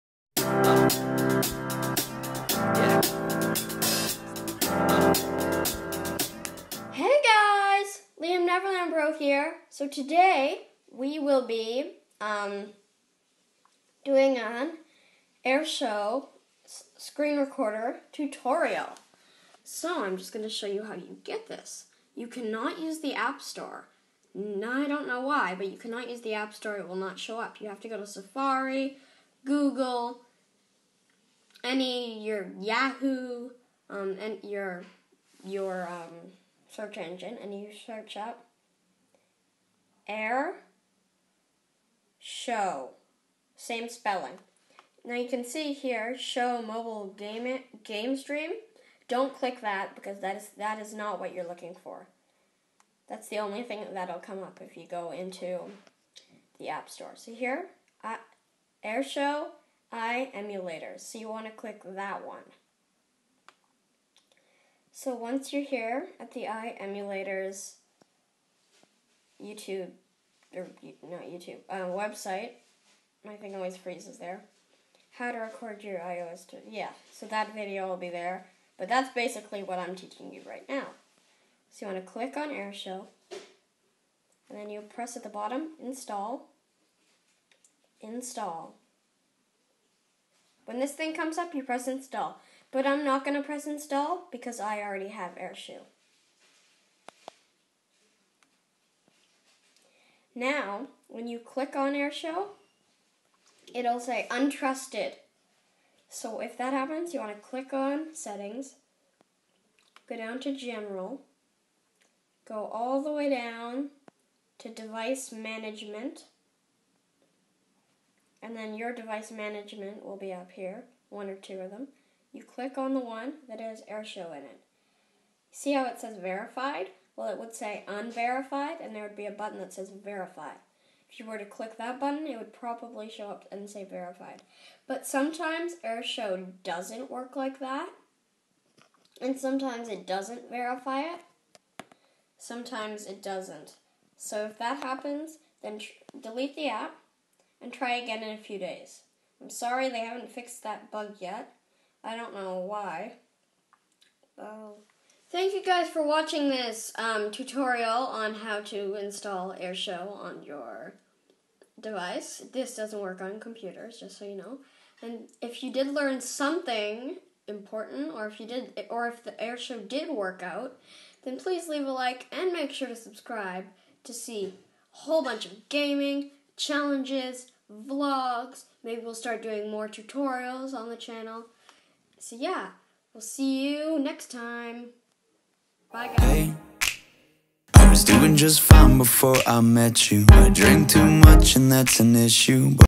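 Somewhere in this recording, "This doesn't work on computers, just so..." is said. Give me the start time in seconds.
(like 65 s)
162 s.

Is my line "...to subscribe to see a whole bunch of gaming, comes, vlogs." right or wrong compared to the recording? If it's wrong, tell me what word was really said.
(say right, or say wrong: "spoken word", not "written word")
wrong: "challenges", not "comes".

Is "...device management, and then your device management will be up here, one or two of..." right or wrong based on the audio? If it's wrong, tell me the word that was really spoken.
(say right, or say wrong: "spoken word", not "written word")
right.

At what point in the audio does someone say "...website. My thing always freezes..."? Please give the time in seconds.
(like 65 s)
71 s.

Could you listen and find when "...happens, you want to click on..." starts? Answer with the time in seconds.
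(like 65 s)
106 s.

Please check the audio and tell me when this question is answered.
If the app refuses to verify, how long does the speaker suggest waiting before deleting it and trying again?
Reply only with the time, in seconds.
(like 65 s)
148 s.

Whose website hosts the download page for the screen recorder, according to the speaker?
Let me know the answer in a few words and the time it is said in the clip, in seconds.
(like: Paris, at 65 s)
iEmulators, at 66 s.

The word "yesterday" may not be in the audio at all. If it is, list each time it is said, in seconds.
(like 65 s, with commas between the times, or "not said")
not said.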